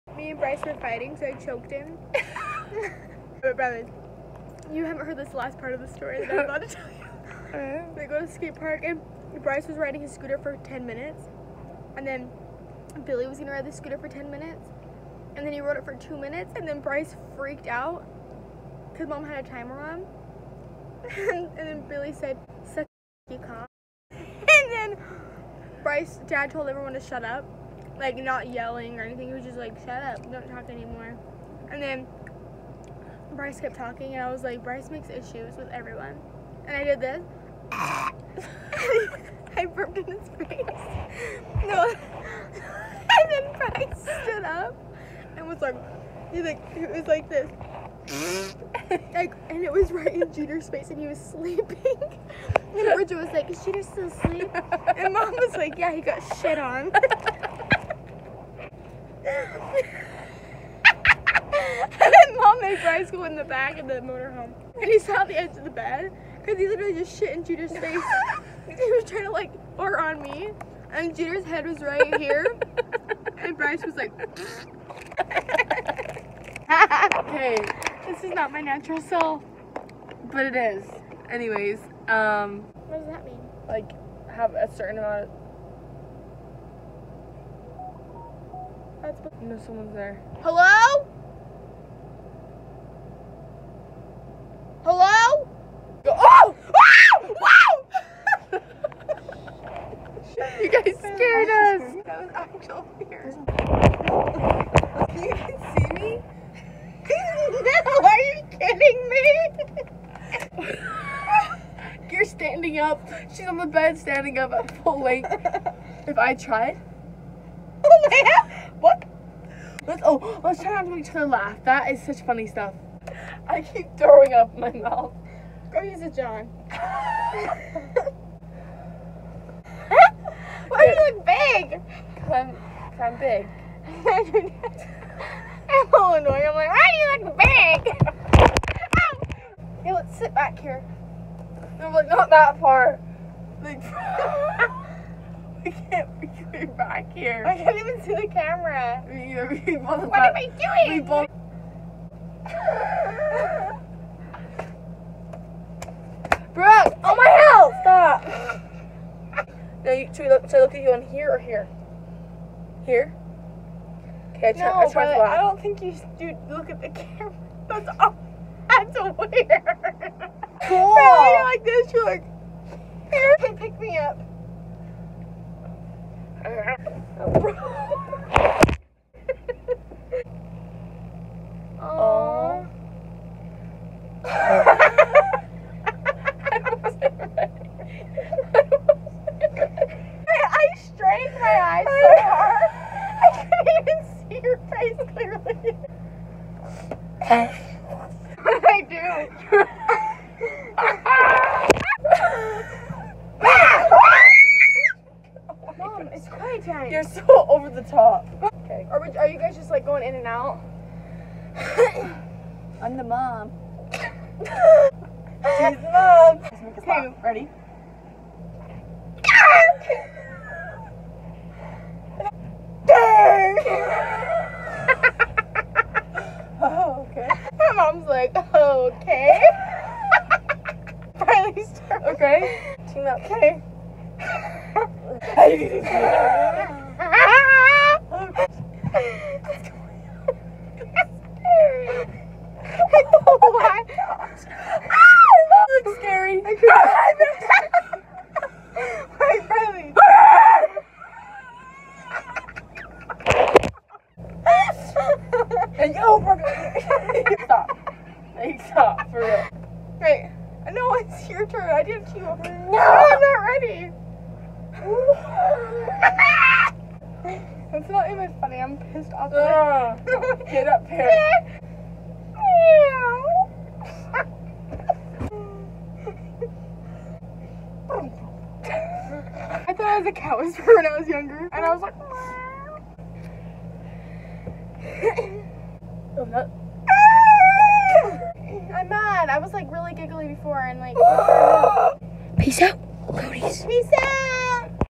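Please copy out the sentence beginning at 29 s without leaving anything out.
He was just like, shut up, don't talk anymore.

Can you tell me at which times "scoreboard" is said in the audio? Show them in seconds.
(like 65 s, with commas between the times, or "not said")
not said.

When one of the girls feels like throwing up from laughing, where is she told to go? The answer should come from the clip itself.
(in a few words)
a John.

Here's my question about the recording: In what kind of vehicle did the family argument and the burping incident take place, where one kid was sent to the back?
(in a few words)
motorhome.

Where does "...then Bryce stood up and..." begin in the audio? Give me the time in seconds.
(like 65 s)
43 s.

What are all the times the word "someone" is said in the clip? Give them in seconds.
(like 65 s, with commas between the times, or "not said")
89 s.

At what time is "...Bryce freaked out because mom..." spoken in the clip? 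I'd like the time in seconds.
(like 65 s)
16 s.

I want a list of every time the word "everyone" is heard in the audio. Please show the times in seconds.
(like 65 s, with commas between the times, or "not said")
26 s, 35 s.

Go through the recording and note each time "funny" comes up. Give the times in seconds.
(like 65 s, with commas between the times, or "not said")
122 s, 268 s.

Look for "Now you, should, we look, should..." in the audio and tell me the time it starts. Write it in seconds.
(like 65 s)
159 s.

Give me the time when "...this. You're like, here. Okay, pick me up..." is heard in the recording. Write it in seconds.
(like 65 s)
171 s.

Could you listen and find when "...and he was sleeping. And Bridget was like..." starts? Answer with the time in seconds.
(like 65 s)
50 s.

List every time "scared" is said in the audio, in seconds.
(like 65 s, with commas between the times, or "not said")
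100 s.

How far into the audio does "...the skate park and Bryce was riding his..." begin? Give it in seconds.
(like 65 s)
8 s.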